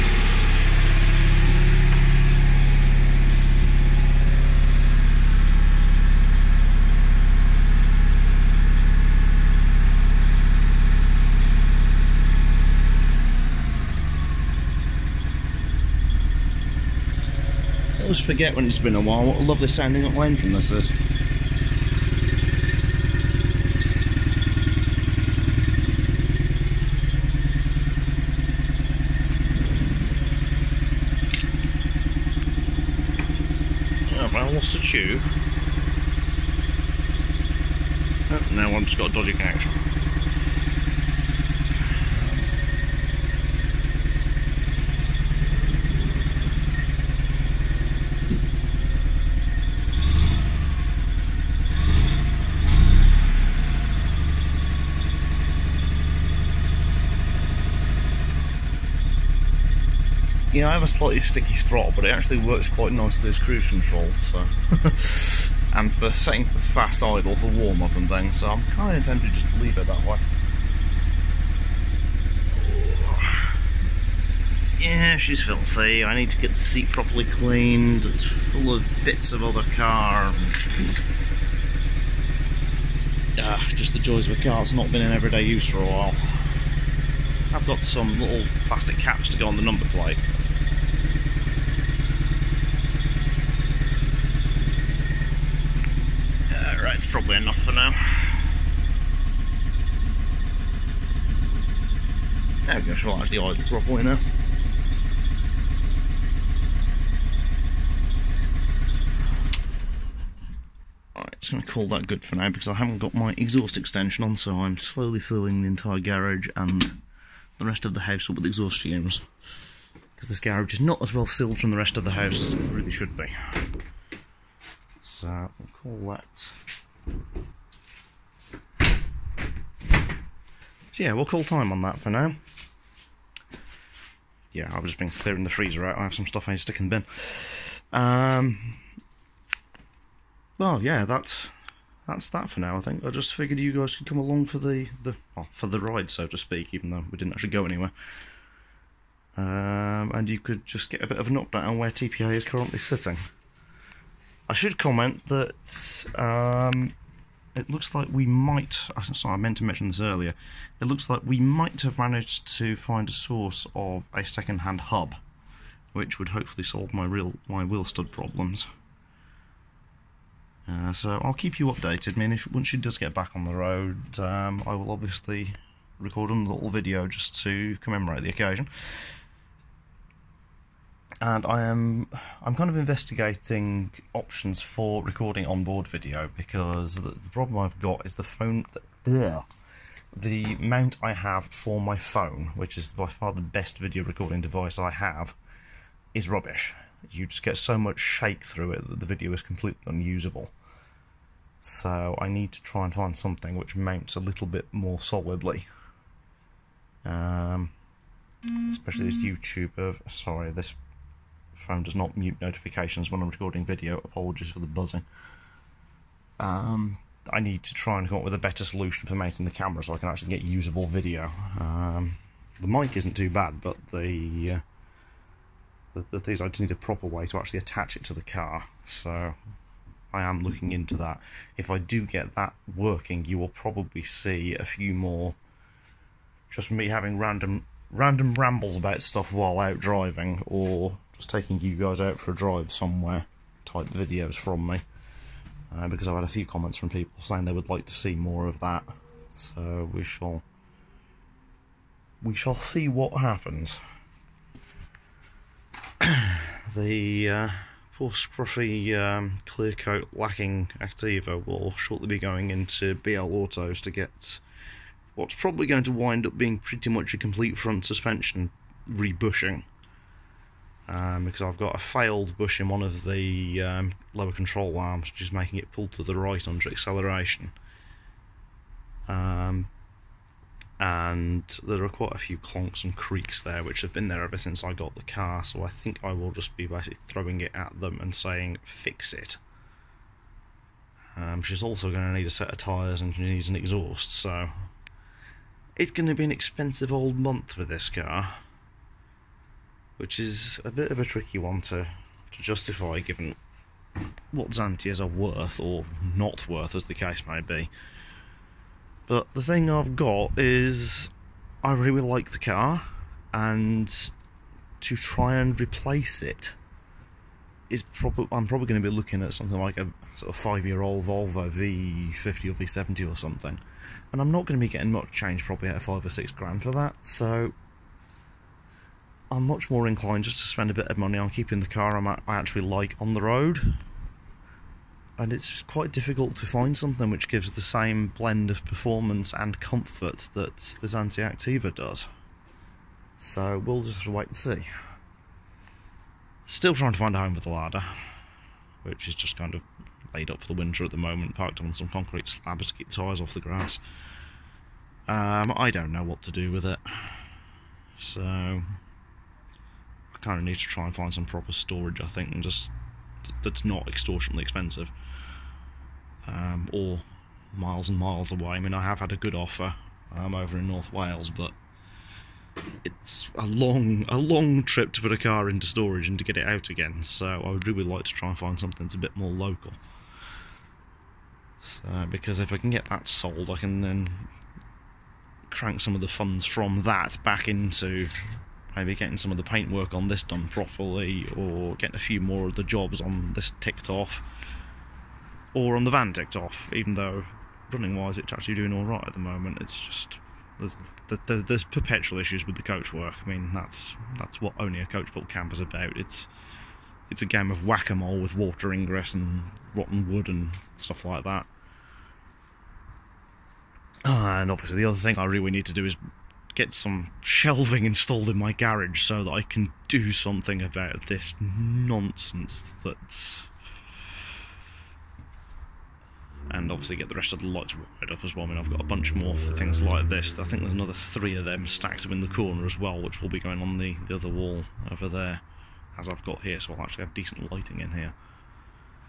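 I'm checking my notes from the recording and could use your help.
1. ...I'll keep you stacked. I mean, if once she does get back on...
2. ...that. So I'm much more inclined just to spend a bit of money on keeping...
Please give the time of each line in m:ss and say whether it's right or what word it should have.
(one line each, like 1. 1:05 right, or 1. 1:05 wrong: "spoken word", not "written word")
1. 2:51 wrong: "updated", not "stacked"
2. 5:26 right.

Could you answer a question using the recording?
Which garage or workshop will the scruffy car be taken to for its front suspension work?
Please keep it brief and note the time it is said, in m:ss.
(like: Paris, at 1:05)
BL Autos, at 4:22.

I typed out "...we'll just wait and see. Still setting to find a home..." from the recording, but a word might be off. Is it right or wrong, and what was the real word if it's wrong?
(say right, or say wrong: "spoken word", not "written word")
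wrong: "trying", not "setting".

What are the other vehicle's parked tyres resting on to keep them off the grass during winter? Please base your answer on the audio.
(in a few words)
concrete slabs.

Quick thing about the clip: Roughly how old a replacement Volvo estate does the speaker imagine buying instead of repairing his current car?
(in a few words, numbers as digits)
5 years old.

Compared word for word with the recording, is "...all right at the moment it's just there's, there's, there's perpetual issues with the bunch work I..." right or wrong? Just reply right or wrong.
wrong.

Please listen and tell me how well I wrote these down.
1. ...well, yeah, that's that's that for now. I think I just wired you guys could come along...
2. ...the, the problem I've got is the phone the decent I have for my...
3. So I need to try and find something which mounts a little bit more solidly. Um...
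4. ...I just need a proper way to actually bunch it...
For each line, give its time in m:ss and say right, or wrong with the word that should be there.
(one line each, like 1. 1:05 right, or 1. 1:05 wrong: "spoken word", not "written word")
1. 2:20 wrong: "figured", not "wired"
2. 3:06 wrong: "mount", not "decent"
3. 3:21 right
4. 3:46 wrong: "attach", not "bunch".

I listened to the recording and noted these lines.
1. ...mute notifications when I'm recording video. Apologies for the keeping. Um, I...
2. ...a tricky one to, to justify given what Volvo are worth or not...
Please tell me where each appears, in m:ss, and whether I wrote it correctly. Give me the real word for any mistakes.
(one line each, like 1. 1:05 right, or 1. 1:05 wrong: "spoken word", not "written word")
1. 3:32 wrong: "buzzing", not "keeping"
2. 5:00 wrong: "Xantias", not "Volvo".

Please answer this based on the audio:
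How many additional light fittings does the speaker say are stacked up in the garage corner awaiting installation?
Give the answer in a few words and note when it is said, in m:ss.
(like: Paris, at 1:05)
3, at 7:10.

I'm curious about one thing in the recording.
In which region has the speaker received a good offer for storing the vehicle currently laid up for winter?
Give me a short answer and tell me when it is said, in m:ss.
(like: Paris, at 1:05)
North Wales, at 6:10.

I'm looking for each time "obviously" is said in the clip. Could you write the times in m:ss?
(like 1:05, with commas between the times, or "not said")
2:54, 6:54, 7:06.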